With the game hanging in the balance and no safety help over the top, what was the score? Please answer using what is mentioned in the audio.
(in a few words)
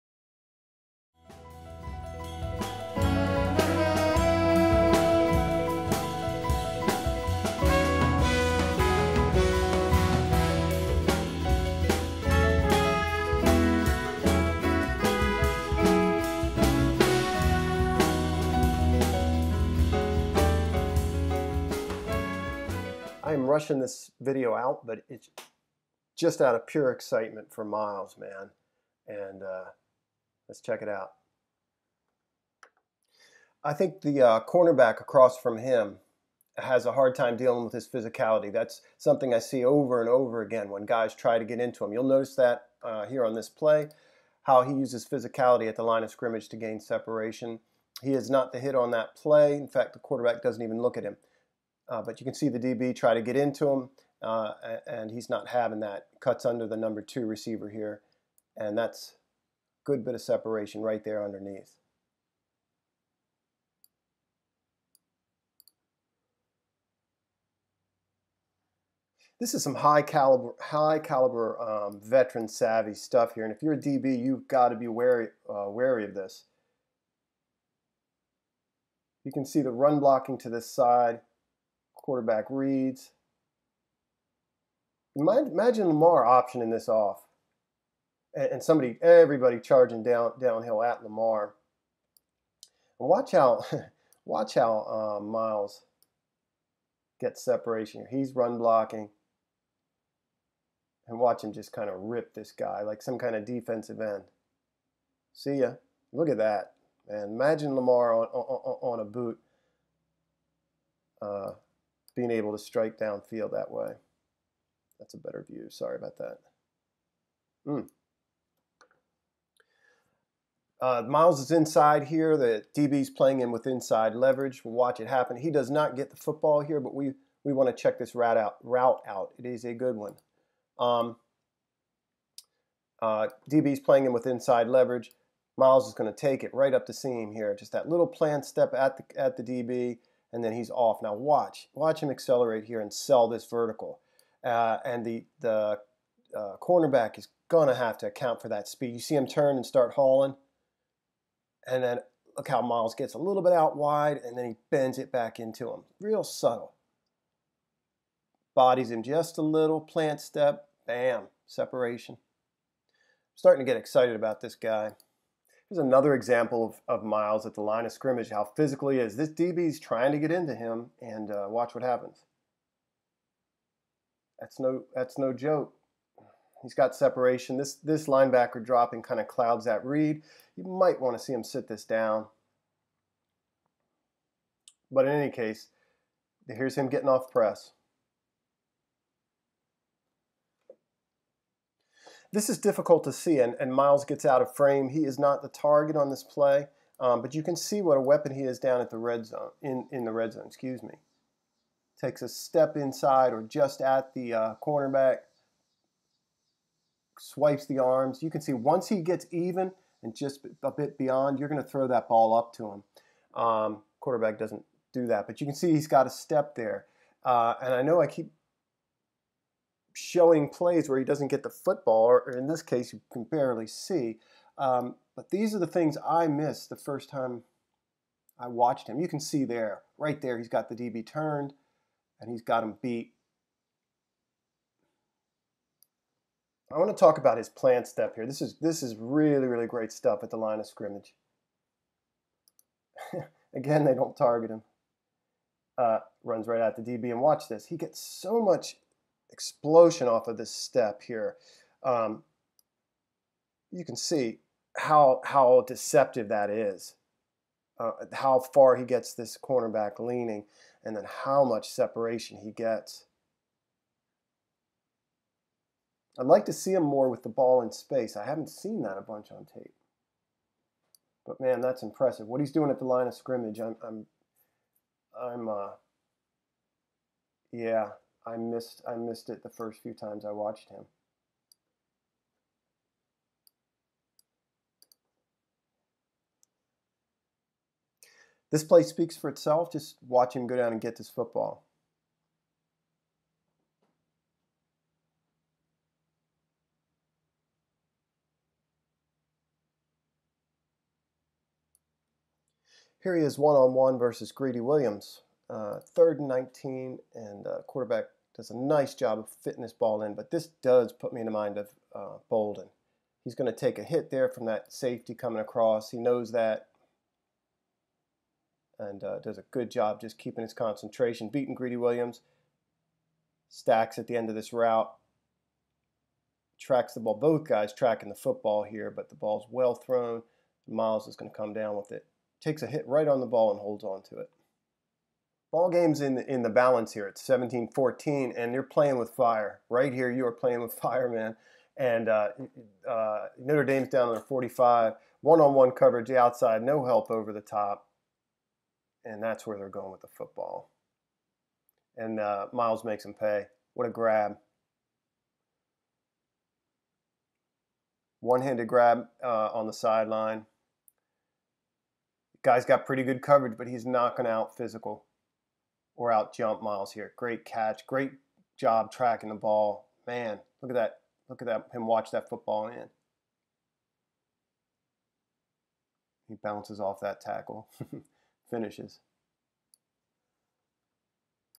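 17-14.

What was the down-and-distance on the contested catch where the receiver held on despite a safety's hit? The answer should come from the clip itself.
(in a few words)
third and 19.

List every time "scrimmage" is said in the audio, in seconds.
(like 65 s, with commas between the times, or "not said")
46 s, 167 s, 240 s, 273 s.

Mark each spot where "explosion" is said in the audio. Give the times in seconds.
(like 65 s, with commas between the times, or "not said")
249 s.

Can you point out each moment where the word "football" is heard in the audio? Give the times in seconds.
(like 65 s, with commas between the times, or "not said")
126 s, 221 s, 291 s, 328 s, 350 s, 372 s.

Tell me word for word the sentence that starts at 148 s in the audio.
You see him turn and start hauling.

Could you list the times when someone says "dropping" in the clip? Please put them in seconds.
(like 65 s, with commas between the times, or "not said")
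178 s.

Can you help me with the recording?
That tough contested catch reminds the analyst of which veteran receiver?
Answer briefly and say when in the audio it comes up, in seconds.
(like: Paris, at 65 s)
Boldin, at 312 s.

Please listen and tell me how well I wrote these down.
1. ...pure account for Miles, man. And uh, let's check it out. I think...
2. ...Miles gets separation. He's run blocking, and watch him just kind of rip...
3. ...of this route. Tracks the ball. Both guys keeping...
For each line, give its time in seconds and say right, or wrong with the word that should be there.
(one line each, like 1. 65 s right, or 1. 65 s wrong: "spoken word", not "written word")
1. 26 s wrong: "excitement", not "account"
2. 95 s right
3. 324 s wrong: "tracking", not "keeping".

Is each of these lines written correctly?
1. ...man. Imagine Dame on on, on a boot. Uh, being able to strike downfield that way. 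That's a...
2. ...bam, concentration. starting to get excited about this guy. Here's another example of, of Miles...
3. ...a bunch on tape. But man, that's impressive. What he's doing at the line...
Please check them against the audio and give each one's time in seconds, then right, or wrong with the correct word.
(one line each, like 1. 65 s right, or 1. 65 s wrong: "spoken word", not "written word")
1. 107 s wrong: "Lamar", not "Dame"
2. 160 s wrong: "separation", not "concentration"
3. 268 s right.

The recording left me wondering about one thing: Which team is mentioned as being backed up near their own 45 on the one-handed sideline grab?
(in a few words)
Notre Dame.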